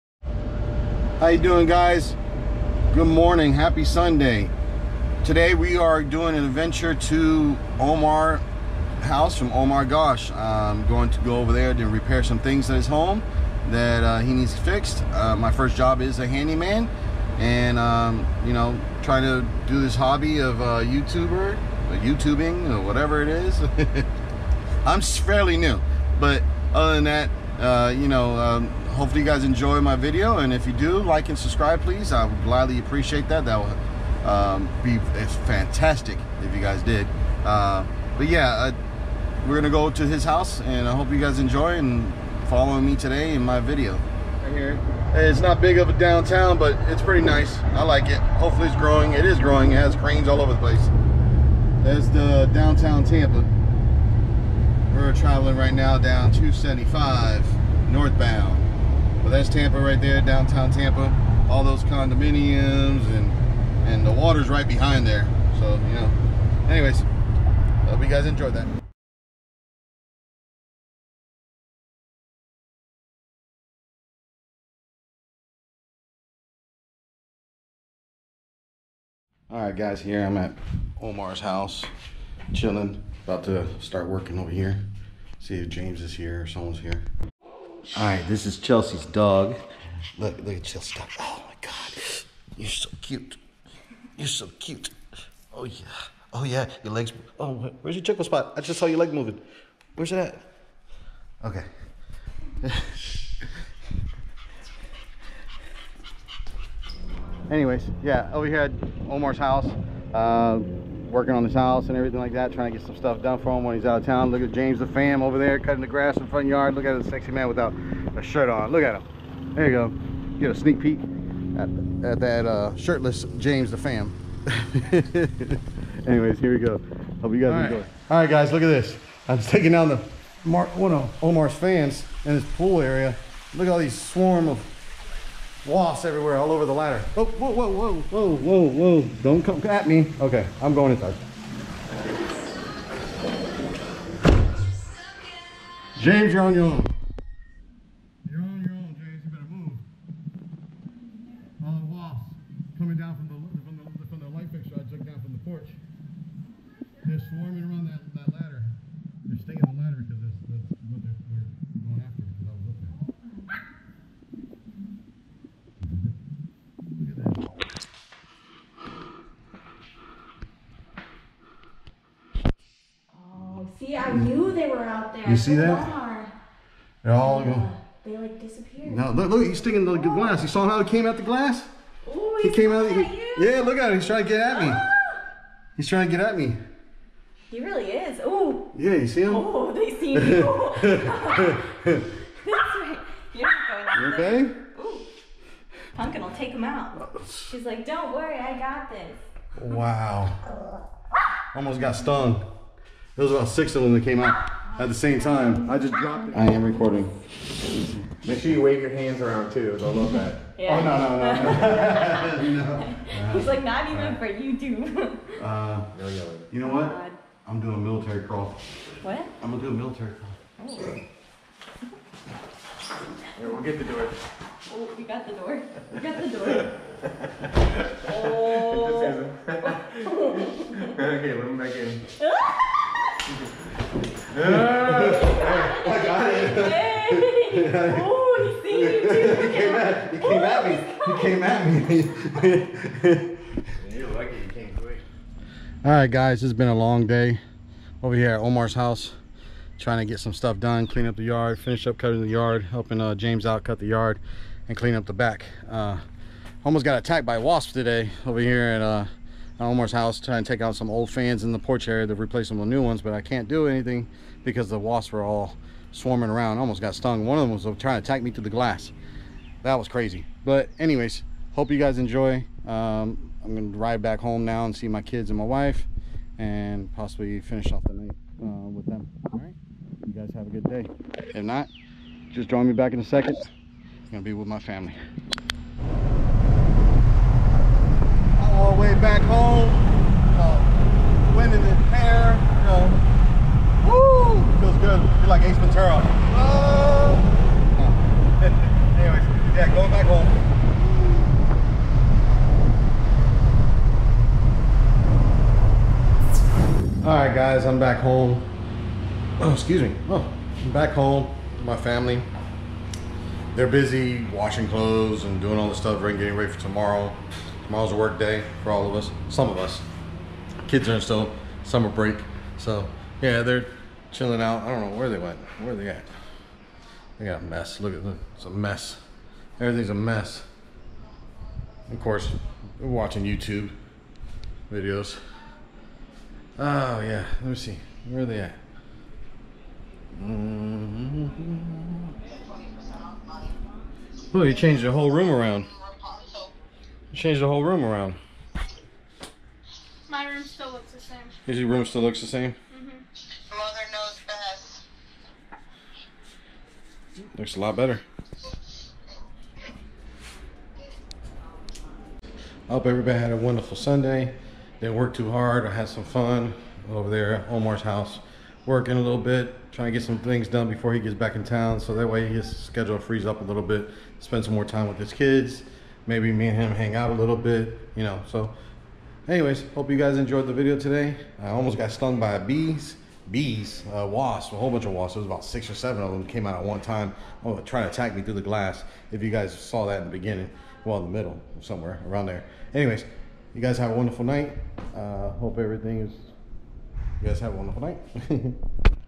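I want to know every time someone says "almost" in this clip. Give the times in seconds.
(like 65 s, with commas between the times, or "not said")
201 s, 256 s, 266 s, 381 s.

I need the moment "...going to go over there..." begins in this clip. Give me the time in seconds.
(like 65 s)
10 s.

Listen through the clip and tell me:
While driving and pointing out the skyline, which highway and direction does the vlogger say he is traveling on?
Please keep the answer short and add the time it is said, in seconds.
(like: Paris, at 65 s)
275 northbound, at 56 s.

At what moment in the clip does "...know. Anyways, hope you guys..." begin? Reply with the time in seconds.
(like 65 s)
65 s.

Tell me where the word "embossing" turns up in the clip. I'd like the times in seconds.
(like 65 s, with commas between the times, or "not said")
not said.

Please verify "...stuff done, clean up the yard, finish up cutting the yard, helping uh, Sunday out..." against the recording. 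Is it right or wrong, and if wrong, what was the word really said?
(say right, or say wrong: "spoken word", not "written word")
wrong: "James", not "Sunday".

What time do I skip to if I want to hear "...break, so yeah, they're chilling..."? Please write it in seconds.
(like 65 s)
321 s.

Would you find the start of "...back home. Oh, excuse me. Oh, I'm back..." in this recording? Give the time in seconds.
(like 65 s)
307 s.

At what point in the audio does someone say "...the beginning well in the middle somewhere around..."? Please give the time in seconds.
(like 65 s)
390 s.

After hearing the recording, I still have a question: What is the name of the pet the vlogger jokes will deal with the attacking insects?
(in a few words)
Pumpkin.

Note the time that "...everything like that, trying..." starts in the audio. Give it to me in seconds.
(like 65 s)
111 s.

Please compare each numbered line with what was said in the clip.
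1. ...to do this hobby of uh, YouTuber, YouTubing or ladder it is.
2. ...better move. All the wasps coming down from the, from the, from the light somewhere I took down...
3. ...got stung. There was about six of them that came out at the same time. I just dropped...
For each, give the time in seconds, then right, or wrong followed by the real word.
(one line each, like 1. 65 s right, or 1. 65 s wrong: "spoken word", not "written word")
1. 19 s wrong: "whatever", not "ladder"
2. 149 s wrong: "fixture", not "somewhere"
3. 201 s right.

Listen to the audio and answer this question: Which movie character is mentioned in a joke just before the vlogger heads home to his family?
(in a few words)
Ace Ventura.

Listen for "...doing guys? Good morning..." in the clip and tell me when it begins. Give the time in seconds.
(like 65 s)
1 s.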